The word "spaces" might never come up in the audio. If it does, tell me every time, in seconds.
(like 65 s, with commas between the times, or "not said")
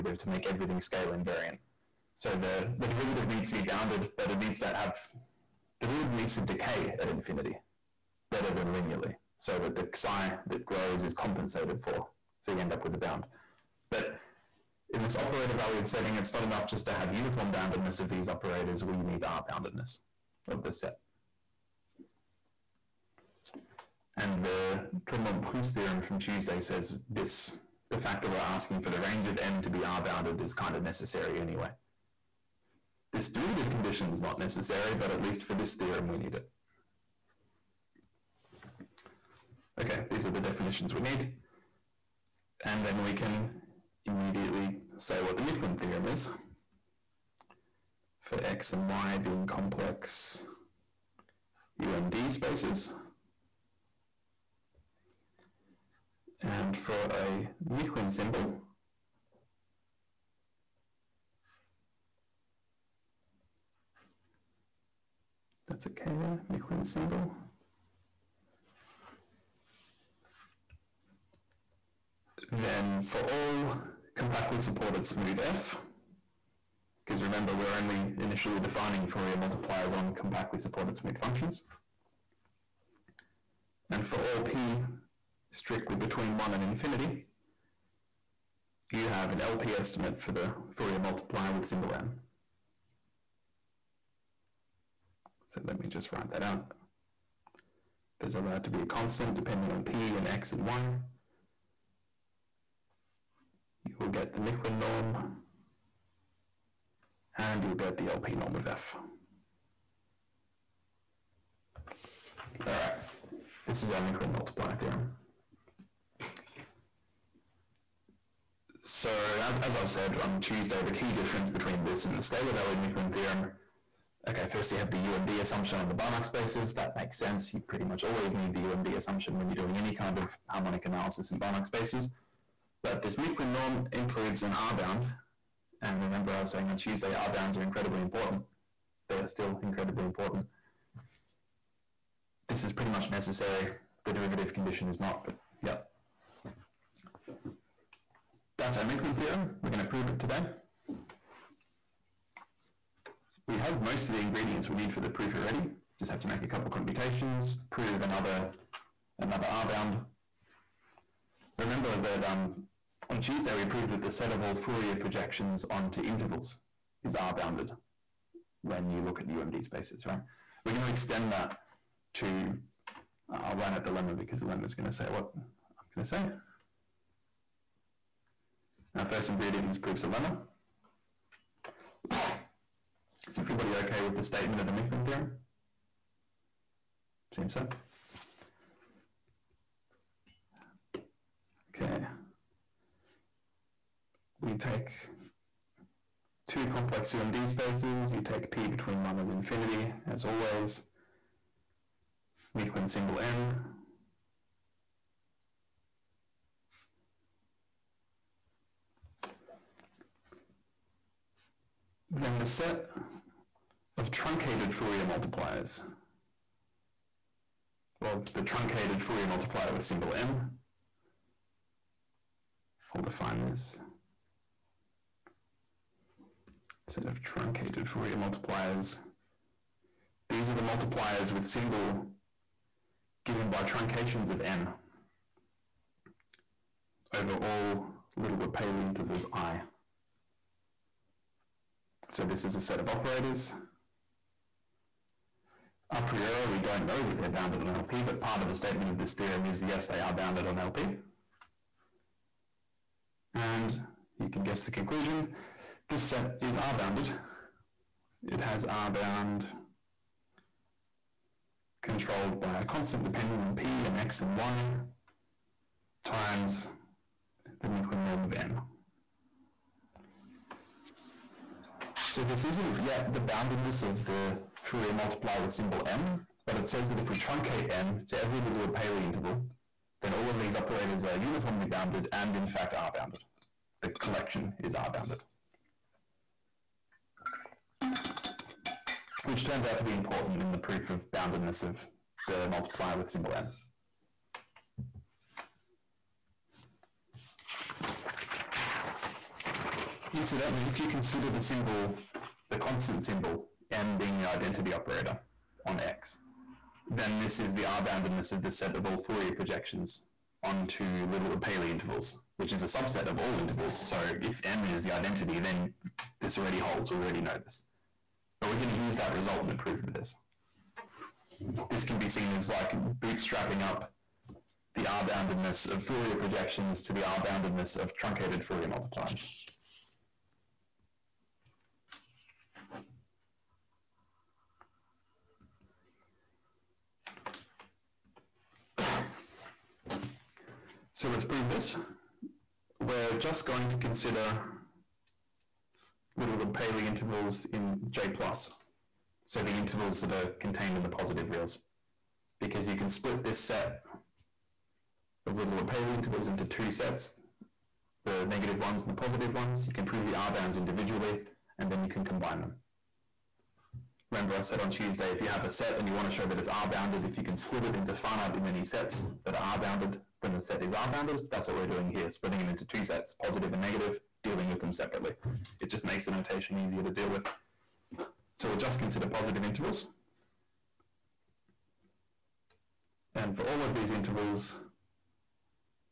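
52 s, 126 s, 131 s, 169 s, 197 s.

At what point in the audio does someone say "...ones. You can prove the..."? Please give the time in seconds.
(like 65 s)
359 s.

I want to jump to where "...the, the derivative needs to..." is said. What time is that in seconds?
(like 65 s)
2 s.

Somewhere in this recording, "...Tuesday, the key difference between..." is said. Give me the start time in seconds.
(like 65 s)
120 s.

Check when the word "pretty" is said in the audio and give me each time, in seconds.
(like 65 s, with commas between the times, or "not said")
127 s, 142 s.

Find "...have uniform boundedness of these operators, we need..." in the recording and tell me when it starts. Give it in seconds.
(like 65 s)
16 s.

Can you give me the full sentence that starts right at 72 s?
Then for all compactly supported smooth F, because remember we're only initially defining Fourier multipliers on compactly supported smooth functions.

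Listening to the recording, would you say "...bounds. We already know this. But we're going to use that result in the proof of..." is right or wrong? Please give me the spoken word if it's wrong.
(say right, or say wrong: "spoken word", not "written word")
wrong: "holds", not "bounds".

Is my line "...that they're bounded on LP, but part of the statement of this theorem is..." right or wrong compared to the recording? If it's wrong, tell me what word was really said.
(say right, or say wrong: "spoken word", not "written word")
right.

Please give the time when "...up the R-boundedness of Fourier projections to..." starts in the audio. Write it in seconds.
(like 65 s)
323 s.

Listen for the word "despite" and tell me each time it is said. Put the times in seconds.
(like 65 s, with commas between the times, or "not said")
not said.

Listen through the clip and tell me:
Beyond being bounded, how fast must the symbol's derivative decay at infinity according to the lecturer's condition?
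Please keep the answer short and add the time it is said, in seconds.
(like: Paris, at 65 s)
Better than linearly, at 8 s.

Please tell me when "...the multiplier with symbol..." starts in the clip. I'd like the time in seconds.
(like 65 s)
292 s.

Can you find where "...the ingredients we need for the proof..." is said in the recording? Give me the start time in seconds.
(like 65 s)
154 s.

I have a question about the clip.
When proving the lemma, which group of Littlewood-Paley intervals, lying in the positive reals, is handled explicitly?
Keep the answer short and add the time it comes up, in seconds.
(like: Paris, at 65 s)
J plus, at 347 s.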